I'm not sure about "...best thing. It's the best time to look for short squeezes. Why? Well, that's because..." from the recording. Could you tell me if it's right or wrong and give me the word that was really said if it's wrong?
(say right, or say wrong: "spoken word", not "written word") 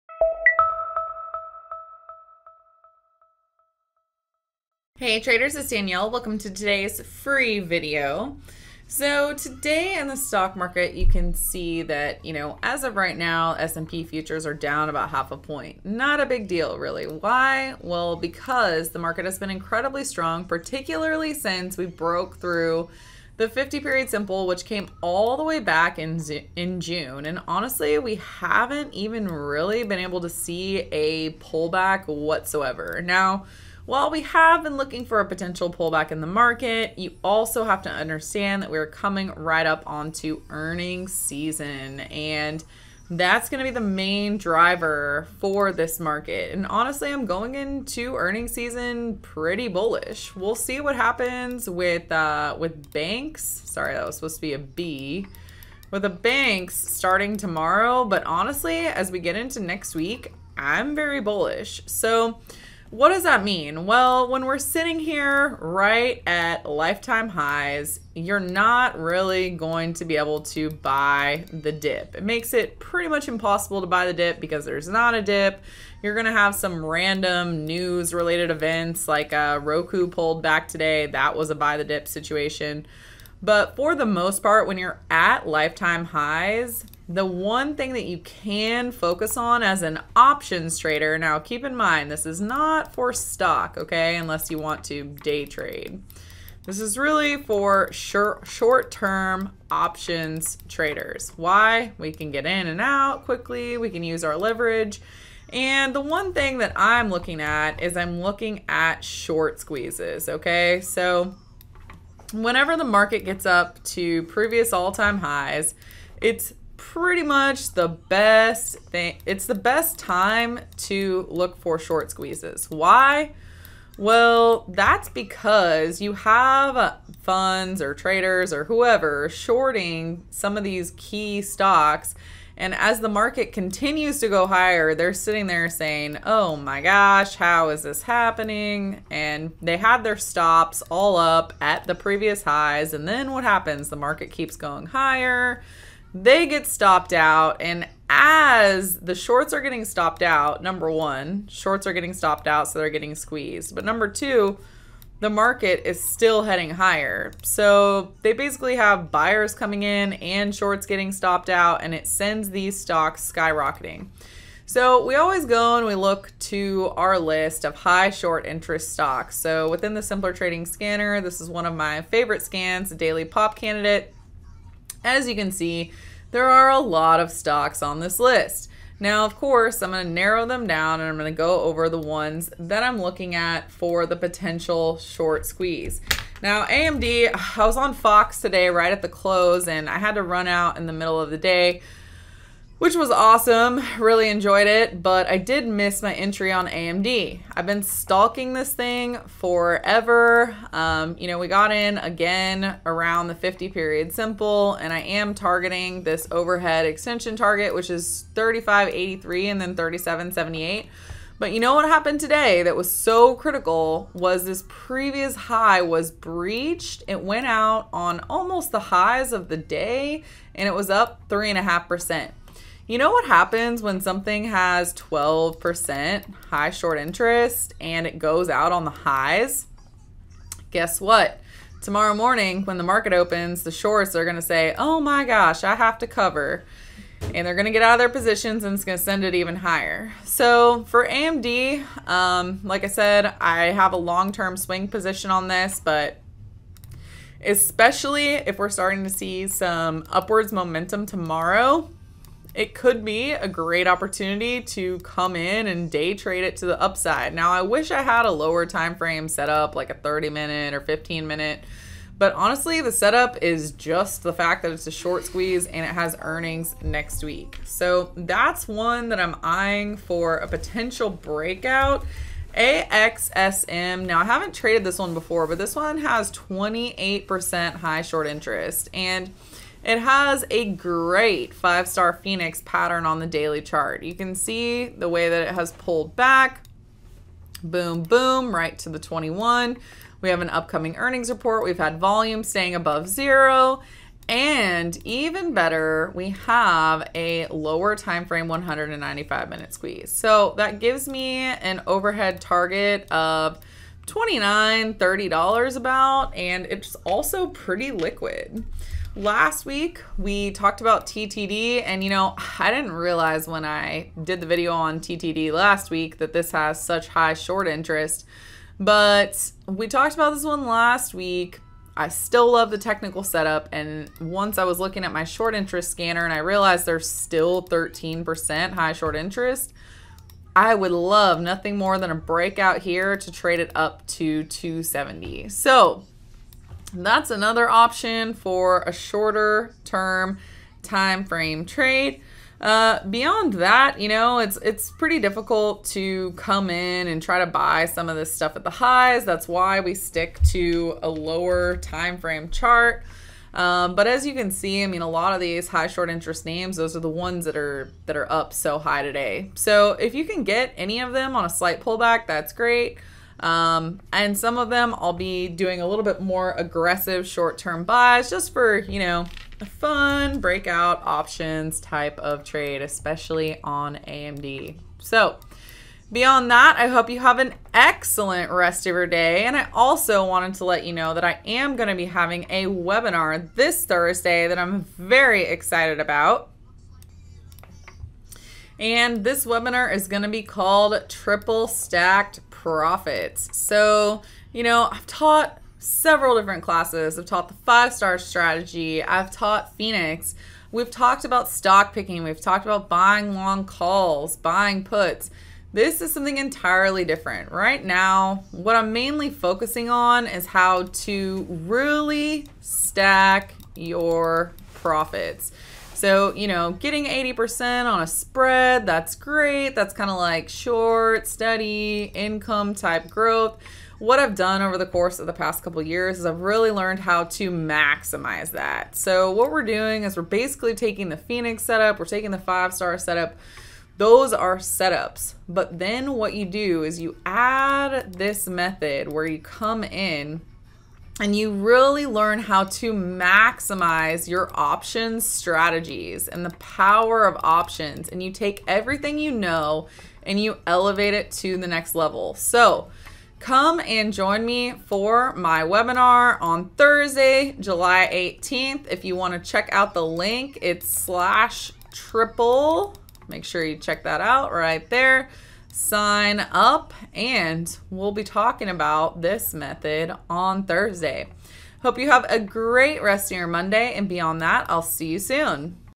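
right.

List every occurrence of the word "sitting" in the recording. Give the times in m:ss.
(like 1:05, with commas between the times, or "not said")
1:04, 2:15.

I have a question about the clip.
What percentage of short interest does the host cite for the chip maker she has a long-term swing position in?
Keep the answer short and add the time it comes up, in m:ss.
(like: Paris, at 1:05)
12%, at 3:44.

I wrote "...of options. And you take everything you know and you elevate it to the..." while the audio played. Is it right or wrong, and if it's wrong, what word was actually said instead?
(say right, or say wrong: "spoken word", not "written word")
right.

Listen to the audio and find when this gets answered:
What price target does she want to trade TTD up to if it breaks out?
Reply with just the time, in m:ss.
5:34.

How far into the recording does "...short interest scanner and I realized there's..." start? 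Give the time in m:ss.
5:25.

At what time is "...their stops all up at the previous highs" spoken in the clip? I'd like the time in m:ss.
2:20.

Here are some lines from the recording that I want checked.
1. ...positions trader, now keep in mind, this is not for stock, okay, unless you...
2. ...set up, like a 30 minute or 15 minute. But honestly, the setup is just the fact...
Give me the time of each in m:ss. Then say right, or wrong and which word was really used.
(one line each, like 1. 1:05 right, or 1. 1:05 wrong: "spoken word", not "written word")
1. 1:30 wrong: "options", not "positions"
2. 4:19 right.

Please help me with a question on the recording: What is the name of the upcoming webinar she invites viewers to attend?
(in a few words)
Triple Stacked Profits.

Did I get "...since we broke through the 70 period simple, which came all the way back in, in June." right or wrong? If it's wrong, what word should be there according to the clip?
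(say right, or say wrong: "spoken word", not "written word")
wrong: "50", not "70".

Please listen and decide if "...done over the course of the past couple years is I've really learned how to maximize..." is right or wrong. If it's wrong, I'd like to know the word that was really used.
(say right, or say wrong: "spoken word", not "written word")
right.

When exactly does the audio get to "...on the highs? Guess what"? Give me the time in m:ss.
3:48.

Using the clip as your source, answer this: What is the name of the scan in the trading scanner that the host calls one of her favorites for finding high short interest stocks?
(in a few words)
Daily Pop Candidate.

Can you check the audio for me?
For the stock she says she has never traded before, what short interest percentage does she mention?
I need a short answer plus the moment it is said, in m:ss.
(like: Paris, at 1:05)
28%, at 4:36.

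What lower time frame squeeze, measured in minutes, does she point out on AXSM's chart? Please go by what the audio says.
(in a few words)
195 minute.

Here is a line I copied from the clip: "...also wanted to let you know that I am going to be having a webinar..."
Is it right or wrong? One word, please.
right.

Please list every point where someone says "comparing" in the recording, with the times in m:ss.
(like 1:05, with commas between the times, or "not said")
not said.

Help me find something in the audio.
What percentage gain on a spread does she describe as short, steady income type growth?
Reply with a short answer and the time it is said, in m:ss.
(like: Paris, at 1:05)
80%, at 6:57.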